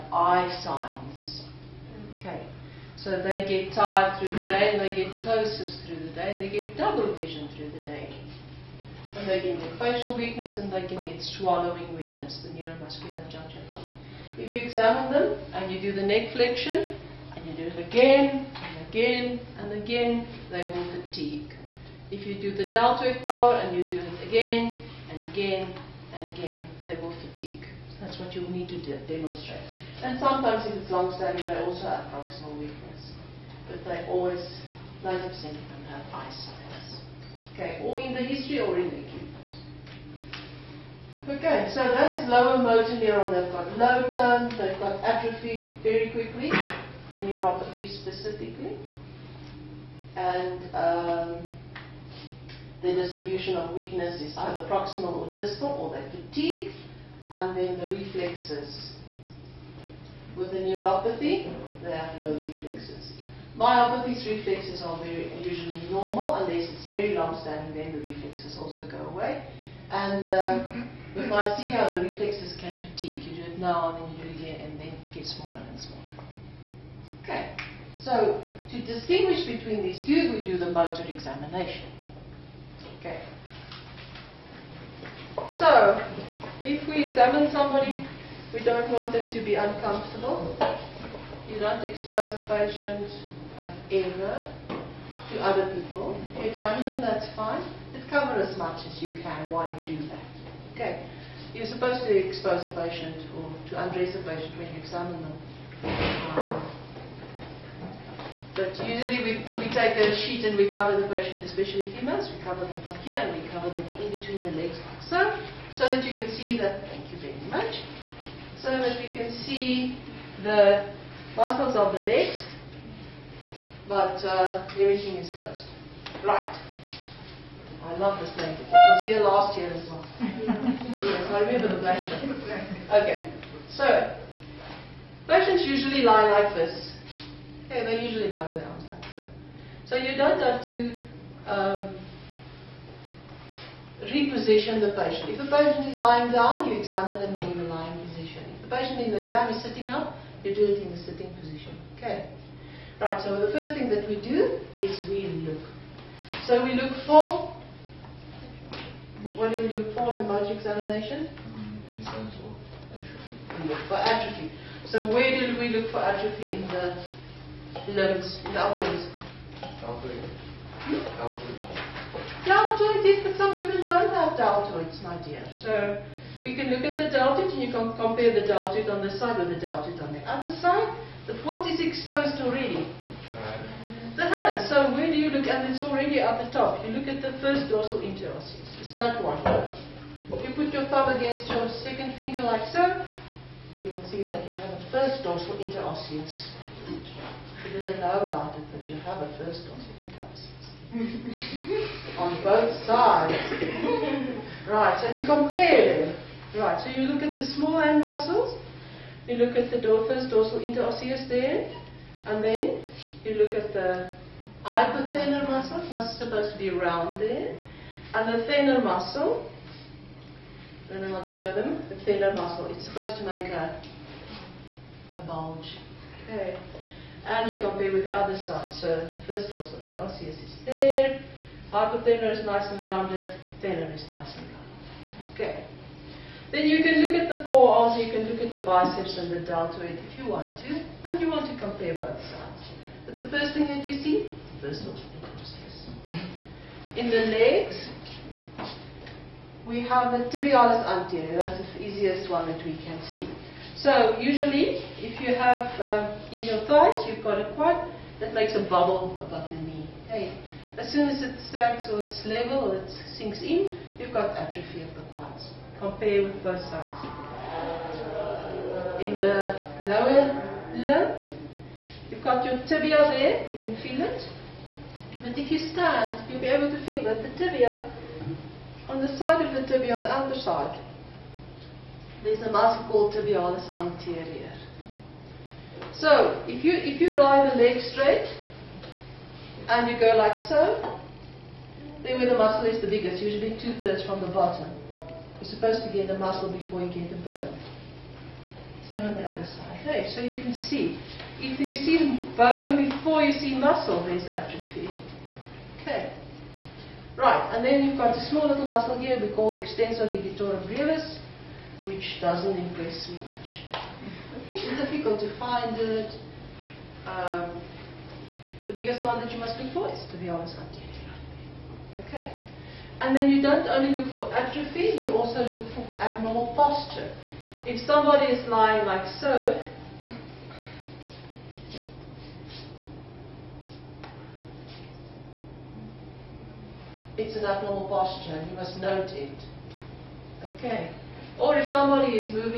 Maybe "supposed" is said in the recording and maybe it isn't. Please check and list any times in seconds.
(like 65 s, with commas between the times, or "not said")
101 s, 216 s, 222 s, 295 s.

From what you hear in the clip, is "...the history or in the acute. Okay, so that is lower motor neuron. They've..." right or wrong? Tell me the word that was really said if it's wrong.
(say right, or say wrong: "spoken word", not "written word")
right.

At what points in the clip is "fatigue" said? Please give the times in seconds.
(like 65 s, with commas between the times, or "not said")
21 s, 27 s, 56 s, 72 s.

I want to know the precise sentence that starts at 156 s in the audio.
So we look for, what do we look for in the motor examination?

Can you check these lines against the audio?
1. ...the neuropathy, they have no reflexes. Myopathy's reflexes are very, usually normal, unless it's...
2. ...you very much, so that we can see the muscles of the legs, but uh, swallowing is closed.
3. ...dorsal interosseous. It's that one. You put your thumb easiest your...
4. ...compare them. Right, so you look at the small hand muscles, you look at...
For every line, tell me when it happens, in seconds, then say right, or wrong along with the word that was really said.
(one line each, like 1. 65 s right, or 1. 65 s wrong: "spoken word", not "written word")
1. 60 s right
2. 117 s wrong: "everything", not "swallowing"
3. 187 s wrong: "against", not "easiest"
4. 205 s right.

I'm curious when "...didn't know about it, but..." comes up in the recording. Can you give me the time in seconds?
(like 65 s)
197 s.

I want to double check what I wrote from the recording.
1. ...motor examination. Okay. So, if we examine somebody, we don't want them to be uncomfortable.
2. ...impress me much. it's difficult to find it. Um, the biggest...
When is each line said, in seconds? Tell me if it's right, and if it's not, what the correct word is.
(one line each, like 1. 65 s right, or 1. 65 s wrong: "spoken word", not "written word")
1. 80 s right
2. 312 s right.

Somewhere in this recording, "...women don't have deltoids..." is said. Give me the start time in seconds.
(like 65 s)
173 s.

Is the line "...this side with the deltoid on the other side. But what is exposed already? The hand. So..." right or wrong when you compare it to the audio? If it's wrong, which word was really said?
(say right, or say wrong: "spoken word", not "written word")
right.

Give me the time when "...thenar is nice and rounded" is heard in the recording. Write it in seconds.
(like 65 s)
233 s.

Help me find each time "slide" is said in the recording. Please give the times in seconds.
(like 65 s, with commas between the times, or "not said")
not said.